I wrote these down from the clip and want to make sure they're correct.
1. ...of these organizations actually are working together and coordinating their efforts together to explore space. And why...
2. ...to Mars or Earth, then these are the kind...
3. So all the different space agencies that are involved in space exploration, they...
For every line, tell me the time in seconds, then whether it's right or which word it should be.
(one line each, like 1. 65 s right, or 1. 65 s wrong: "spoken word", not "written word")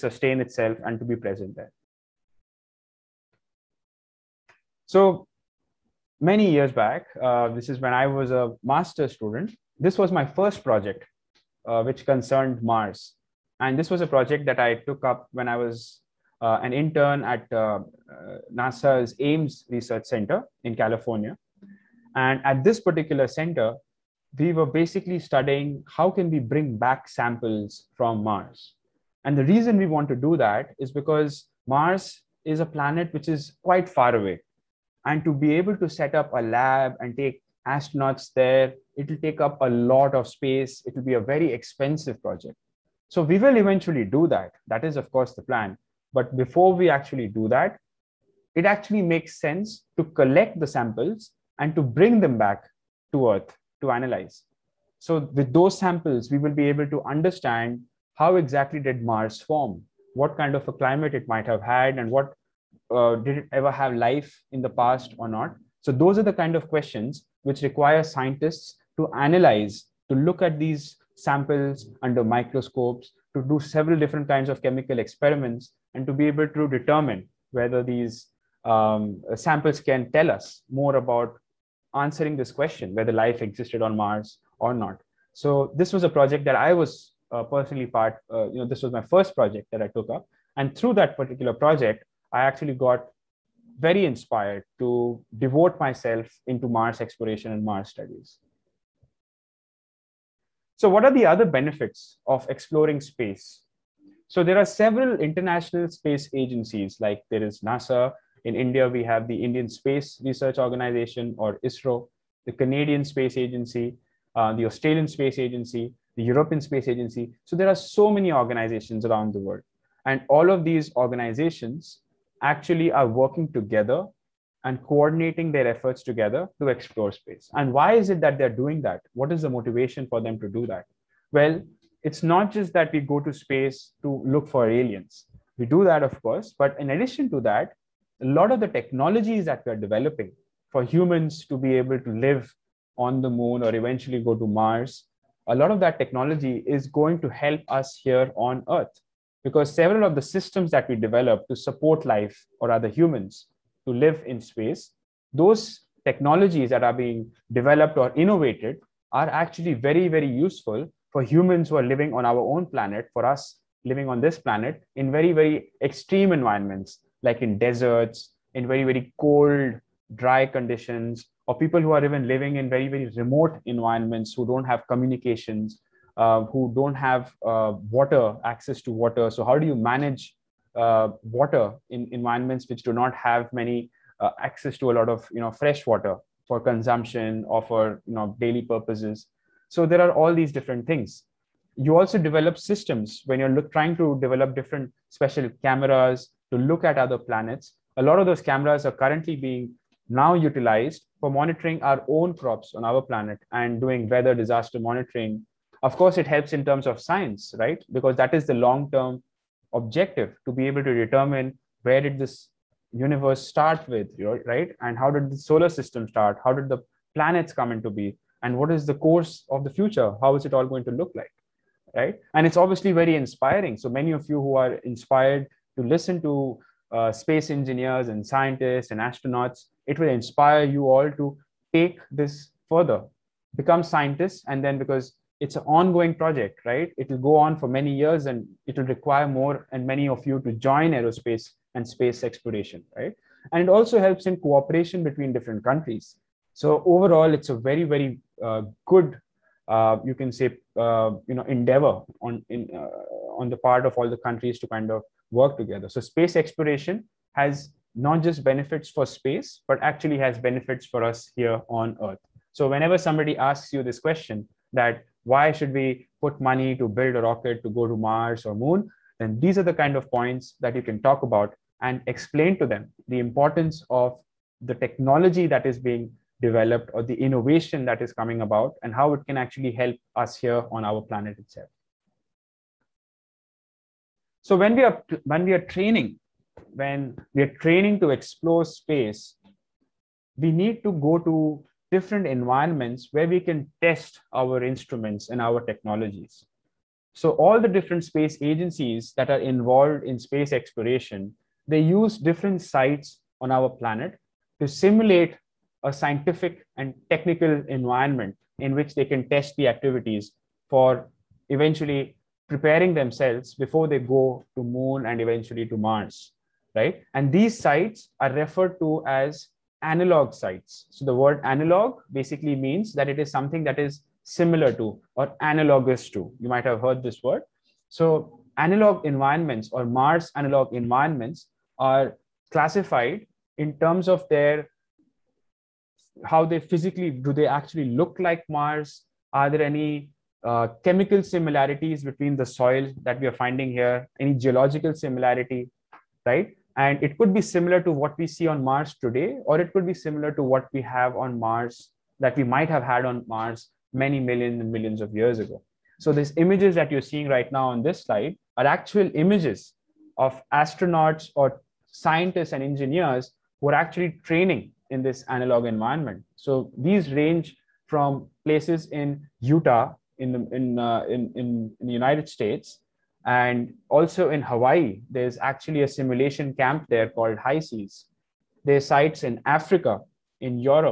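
1. 120 s right
2. 267 s wrong: "Moon", not "Earth"
3. 297 s right.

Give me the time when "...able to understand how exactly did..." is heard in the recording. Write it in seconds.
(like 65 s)
56 s.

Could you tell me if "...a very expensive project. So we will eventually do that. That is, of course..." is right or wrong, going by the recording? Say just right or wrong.
right.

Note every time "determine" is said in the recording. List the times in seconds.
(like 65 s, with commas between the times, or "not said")
76 s, 210 s.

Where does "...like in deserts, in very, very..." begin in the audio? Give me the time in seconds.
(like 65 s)
167 s.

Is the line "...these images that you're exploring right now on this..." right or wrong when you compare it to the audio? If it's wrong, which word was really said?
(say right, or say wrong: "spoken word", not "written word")
wrong: "seeing", not "exploring".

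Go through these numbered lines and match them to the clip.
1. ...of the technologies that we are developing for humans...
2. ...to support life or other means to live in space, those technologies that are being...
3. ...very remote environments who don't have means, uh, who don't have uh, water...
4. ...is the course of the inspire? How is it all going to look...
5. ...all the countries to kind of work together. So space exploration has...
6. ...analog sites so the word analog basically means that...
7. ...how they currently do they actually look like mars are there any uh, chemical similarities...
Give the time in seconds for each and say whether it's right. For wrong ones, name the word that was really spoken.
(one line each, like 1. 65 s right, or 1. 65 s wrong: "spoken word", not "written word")
1. 138 s right
2. 151 s wrong: "humans", not "means"
3. 172 s wrong: "communications", not "means"
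4. 218 s wrong: "future", not "inspire"
5. 253 s right
6. 319 s right
7. 336 s wrong: "physically", not "currently".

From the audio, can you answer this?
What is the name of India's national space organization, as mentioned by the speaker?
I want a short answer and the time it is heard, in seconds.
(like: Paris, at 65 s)
Indian Space Research Organization, at 109 s.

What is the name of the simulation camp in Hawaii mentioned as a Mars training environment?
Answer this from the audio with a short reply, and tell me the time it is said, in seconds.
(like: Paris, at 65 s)
High Seas, at 377 s.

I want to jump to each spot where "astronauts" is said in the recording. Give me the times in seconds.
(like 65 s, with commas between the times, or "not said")
37 s, 228 s, 360 s.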